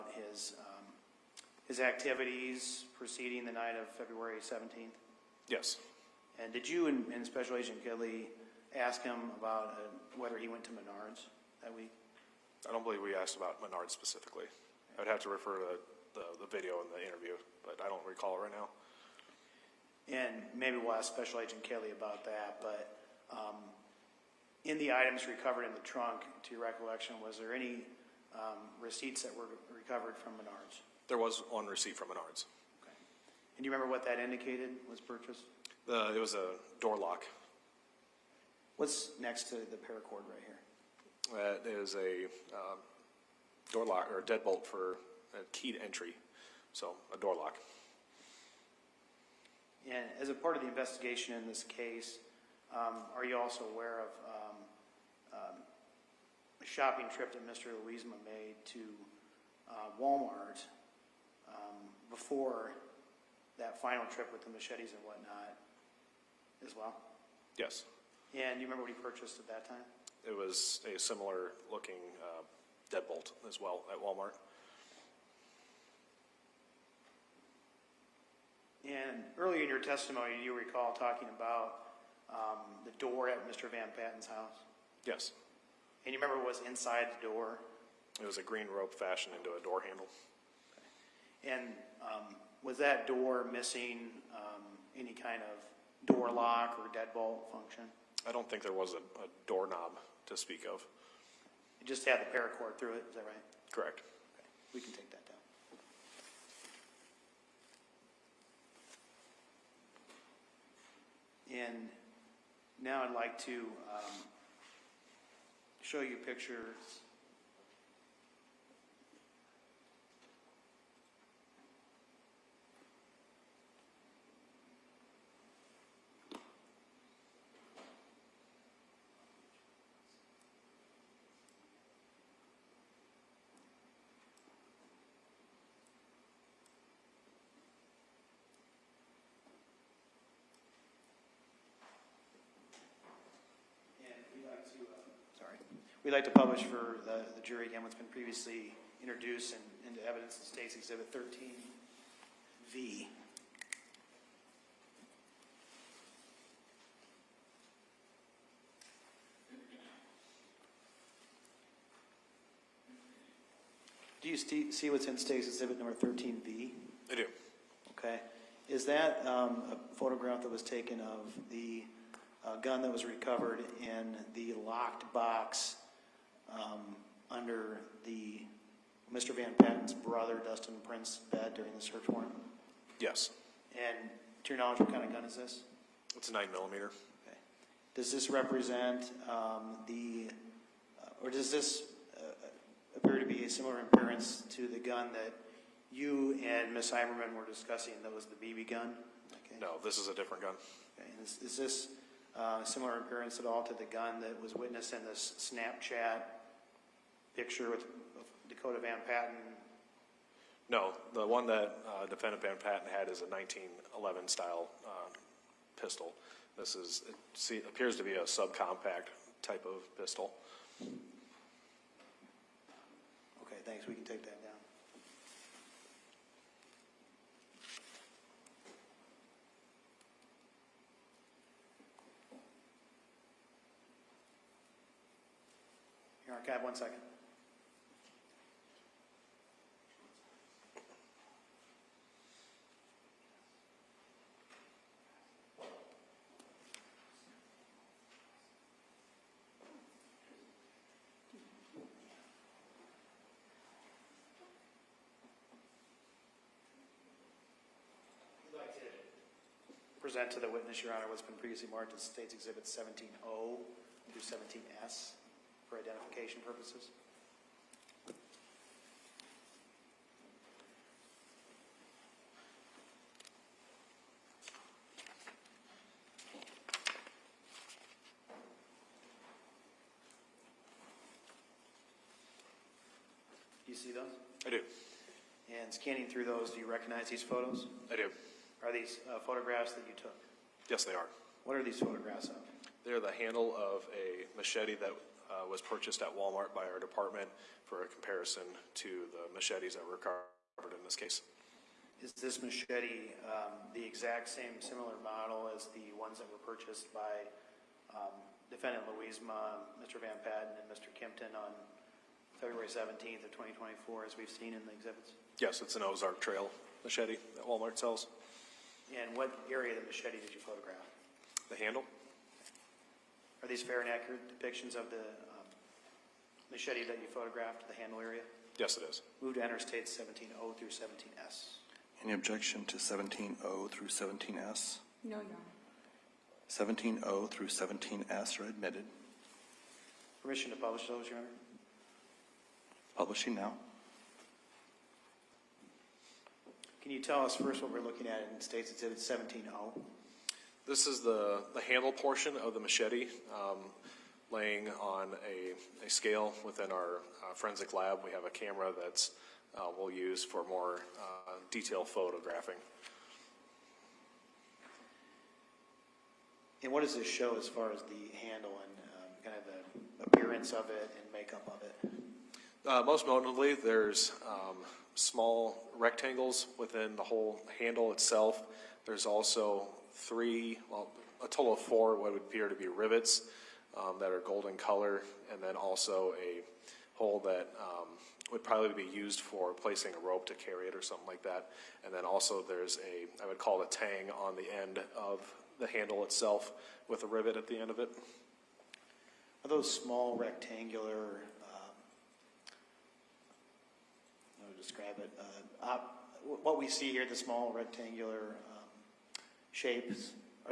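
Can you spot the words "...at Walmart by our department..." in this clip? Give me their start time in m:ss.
4:56.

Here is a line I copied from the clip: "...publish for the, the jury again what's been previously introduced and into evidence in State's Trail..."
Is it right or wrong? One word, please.
wrong.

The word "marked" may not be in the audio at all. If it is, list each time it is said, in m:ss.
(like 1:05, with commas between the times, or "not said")
4:21.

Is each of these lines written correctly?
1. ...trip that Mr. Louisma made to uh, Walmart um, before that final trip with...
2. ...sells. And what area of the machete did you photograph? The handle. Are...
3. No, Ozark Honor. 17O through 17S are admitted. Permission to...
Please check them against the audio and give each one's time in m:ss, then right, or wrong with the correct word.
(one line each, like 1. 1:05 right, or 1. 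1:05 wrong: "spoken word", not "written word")
1. 0:57 right
2. 5:17 right
3. 5:35 wrong: "Your", not "Ozark".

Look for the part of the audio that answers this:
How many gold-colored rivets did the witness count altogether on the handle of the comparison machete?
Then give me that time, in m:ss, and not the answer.
6:21.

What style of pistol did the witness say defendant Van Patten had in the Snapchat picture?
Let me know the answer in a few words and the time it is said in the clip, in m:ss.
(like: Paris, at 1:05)
1911 style, at 3:33.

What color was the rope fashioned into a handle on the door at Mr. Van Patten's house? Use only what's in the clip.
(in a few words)
Green.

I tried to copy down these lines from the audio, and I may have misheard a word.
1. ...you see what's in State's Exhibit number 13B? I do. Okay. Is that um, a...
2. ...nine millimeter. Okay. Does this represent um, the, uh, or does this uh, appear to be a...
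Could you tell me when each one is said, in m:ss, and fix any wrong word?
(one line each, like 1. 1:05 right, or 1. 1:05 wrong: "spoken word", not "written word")
1. 2:44 right
2. 3:06 right.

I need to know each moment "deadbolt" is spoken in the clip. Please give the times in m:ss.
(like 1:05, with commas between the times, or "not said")
0:44, 1:12, 1:36.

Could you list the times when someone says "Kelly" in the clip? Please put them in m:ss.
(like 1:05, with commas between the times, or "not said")
0:07, 0:21.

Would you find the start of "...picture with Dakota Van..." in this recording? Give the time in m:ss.
3:27.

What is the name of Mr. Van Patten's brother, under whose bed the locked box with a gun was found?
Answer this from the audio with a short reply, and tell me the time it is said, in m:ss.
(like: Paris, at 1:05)
Dustin Prince, at 3:00.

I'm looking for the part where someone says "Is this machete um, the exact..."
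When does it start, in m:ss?
5:02.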